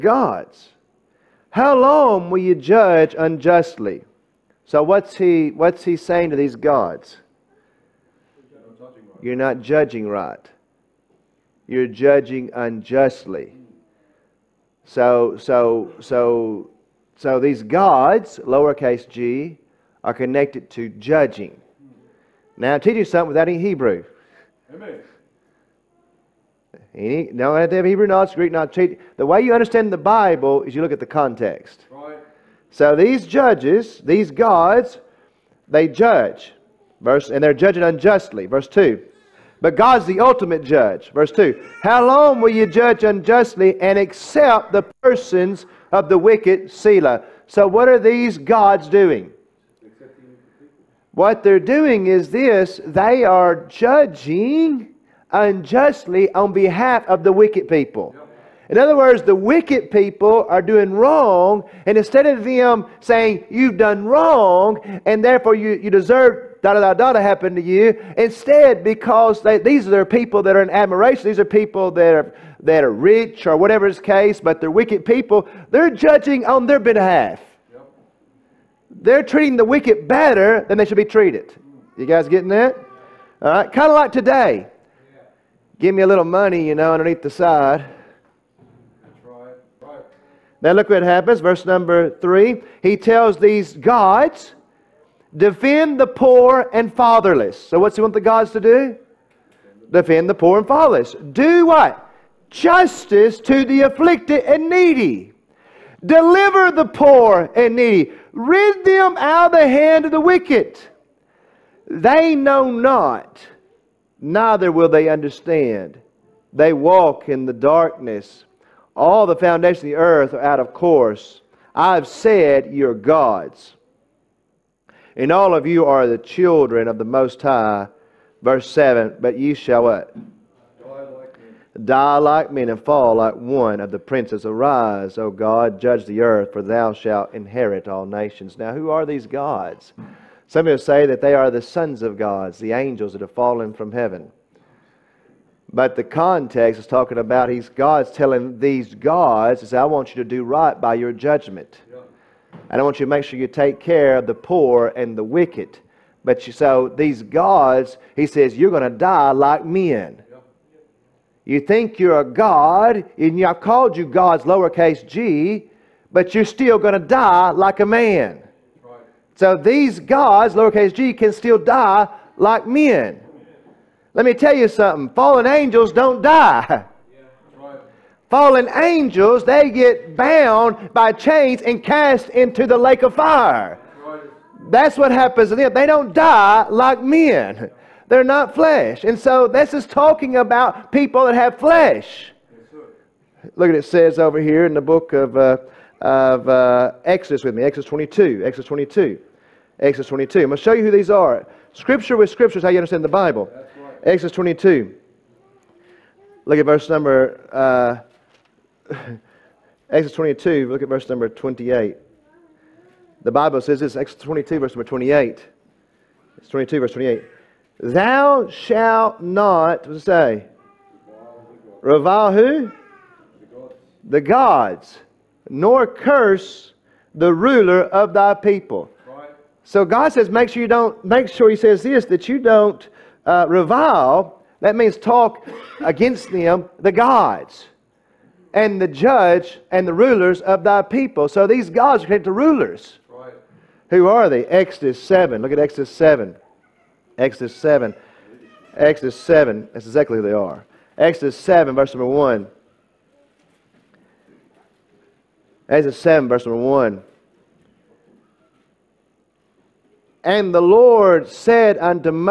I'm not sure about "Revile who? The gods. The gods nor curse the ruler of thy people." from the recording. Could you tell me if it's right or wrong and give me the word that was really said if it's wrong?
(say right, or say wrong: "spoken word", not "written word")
right.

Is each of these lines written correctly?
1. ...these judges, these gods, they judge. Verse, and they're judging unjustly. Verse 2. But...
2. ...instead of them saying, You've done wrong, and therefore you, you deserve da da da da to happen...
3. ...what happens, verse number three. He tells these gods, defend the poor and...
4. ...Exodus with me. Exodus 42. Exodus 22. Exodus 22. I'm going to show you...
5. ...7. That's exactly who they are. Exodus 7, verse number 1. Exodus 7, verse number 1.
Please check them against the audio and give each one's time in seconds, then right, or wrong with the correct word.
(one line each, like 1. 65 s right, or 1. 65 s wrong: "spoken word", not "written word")
1. 32 s right
2. 61 s right
3. 90 s right
4. 197 s wrong: "22", not "42"
5. 249 s right.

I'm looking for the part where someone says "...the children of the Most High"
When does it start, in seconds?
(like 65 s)
126 s.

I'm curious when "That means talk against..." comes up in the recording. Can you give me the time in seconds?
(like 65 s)
234 s.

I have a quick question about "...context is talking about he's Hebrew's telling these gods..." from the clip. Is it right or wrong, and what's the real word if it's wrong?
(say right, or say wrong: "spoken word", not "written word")
wrong: "God", not "Hebrew".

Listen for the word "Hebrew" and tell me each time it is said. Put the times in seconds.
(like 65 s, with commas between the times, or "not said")
23 s, 27 s.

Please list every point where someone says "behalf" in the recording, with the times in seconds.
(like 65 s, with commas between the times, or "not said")
56 s, 76 s.